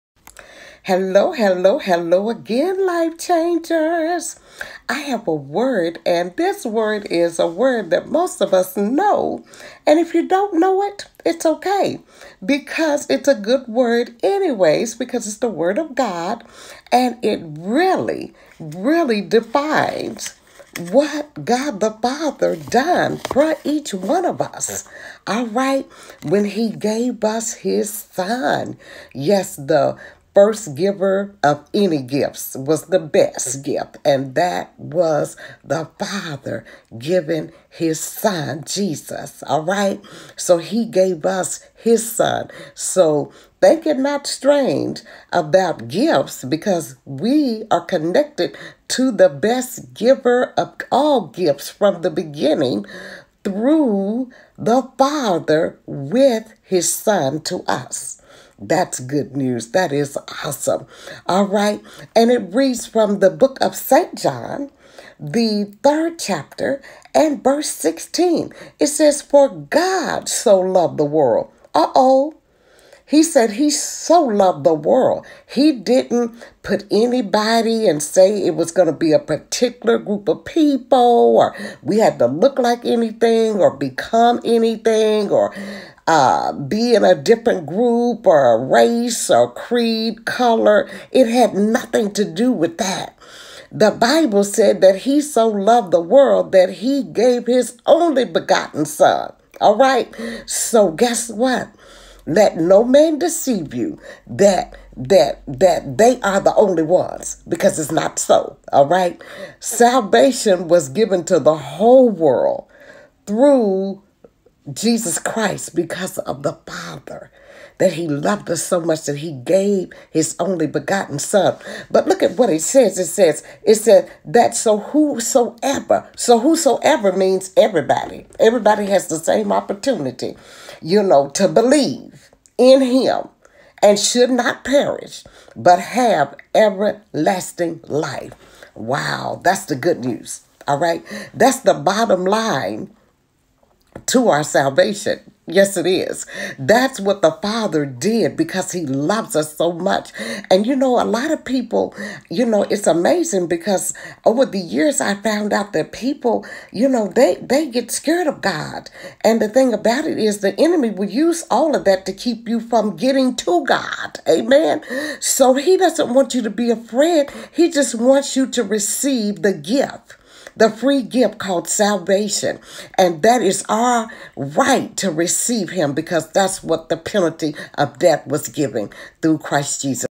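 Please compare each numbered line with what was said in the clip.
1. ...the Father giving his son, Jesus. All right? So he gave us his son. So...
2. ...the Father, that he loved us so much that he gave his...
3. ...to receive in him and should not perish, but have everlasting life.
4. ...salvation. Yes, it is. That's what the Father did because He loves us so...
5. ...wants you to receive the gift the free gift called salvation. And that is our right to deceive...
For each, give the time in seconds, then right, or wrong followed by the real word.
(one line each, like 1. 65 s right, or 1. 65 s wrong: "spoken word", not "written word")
1. 35 s right
2. 116 s right
3. 131 s wrong: "believe", not "receive"
4. 144 s right
5. 167 s wrong: "receive", not "deceive".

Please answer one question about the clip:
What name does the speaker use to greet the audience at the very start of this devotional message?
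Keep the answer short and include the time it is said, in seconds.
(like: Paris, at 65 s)
life changers, at 2 s.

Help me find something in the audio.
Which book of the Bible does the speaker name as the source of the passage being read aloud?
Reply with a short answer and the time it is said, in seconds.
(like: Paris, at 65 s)
St. John, at 63 s.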